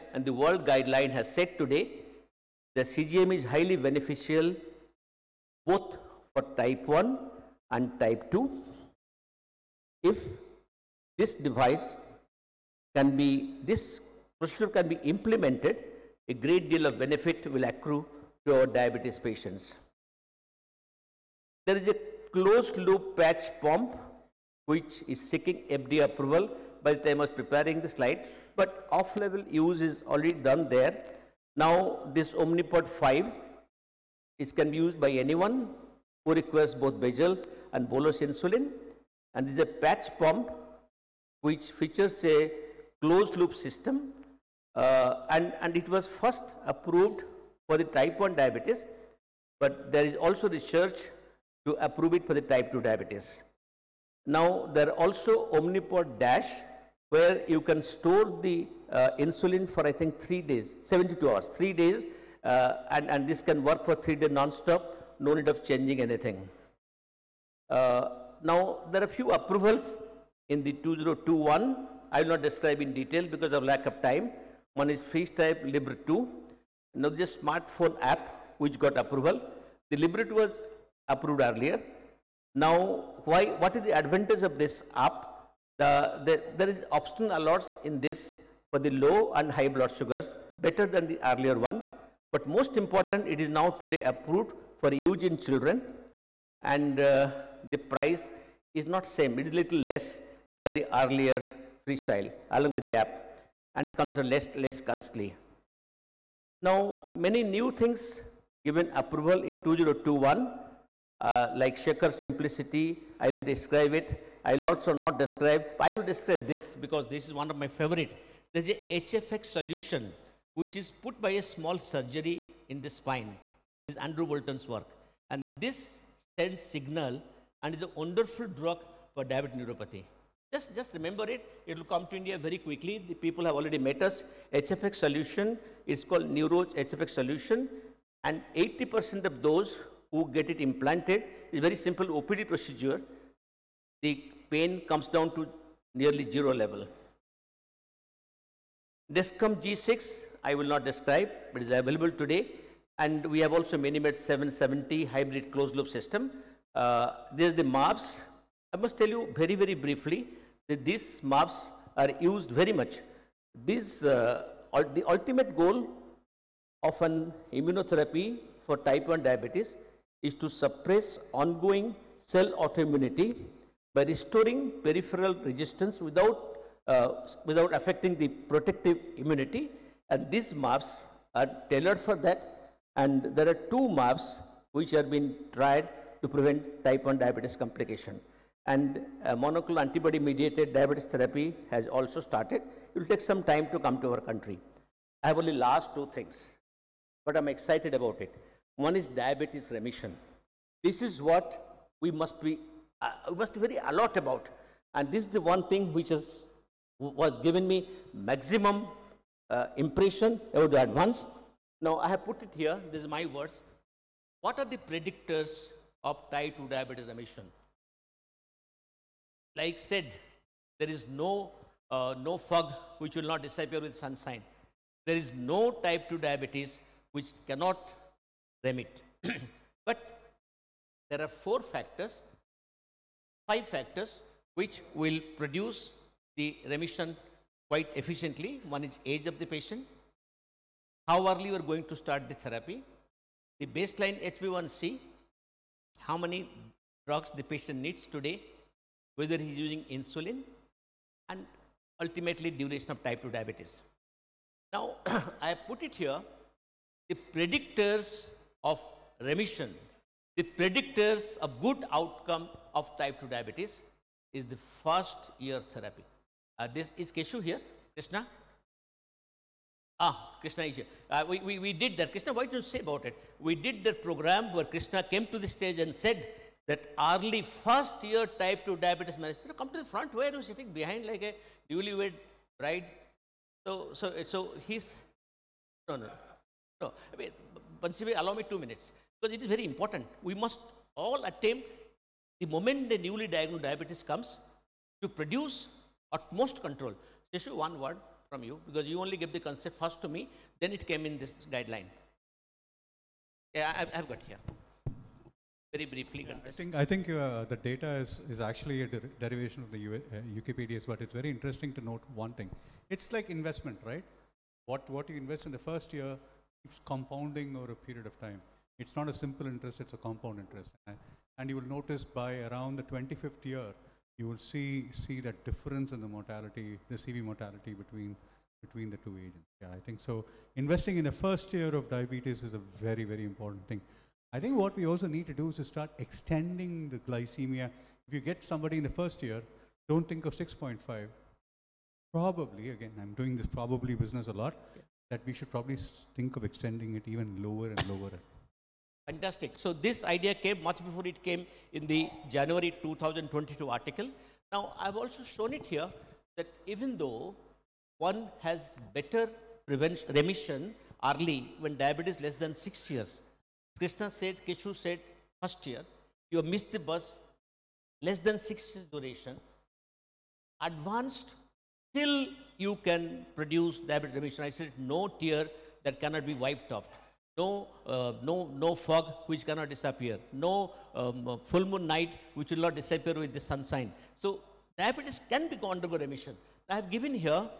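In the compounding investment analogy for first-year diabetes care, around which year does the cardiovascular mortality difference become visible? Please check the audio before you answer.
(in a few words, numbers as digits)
25th year.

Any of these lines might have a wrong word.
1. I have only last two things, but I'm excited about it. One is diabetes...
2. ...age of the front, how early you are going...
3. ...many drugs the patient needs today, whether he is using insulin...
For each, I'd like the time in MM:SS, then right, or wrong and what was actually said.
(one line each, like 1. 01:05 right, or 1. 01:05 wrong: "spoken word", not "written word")
1. 03:15 right
2. 03:59 wrong: "patient", not "front"
3. 04:06 right.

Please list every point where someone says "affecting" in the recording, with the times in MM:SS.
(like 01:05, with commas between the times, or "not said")
02:57.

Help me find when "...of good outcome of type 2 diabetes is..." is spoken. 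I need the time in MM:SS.
04:21.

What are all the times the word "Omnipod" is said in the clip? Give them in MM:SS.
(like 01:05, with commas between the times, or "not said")
00:32, 00:55.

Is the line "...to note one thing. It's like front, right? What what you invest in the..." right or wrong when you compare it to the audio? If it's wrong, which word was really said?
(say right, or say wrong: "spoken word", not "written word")
wrong: "investment", not "front".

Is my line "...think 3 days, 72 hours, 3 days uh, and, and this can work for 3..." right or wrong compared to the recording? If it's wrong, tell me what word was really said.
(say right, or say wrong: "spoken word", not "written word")
right.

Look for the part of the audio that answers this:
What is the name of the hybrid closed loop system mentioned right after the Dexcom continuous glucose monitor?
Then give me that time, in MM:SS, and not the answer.
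02:33.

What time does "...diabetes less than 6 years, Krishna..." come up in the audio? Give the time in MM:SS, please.
06:01.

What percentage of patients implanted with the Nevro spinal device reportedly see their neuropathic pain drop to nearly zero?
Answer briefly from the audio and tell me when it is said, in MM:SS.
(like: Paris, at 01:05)
80%, at 02:18.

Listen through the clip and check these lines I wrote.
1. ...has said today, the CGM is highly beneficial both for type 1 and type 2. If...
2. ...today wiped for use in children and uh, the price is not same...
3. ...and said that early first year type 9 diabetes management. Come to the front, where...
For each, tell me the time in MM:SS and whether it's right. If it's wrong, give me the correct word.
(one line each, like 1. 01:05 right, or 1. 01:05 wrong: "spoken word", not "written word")
1. 00:01 right
2. 01:33 wrong: "approved", not "wiped"
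3. 04:35 wrong: "2", not "9".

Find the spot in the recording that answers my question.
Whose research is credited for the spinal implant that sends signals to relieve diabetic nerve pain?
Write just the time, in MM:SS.
02:04.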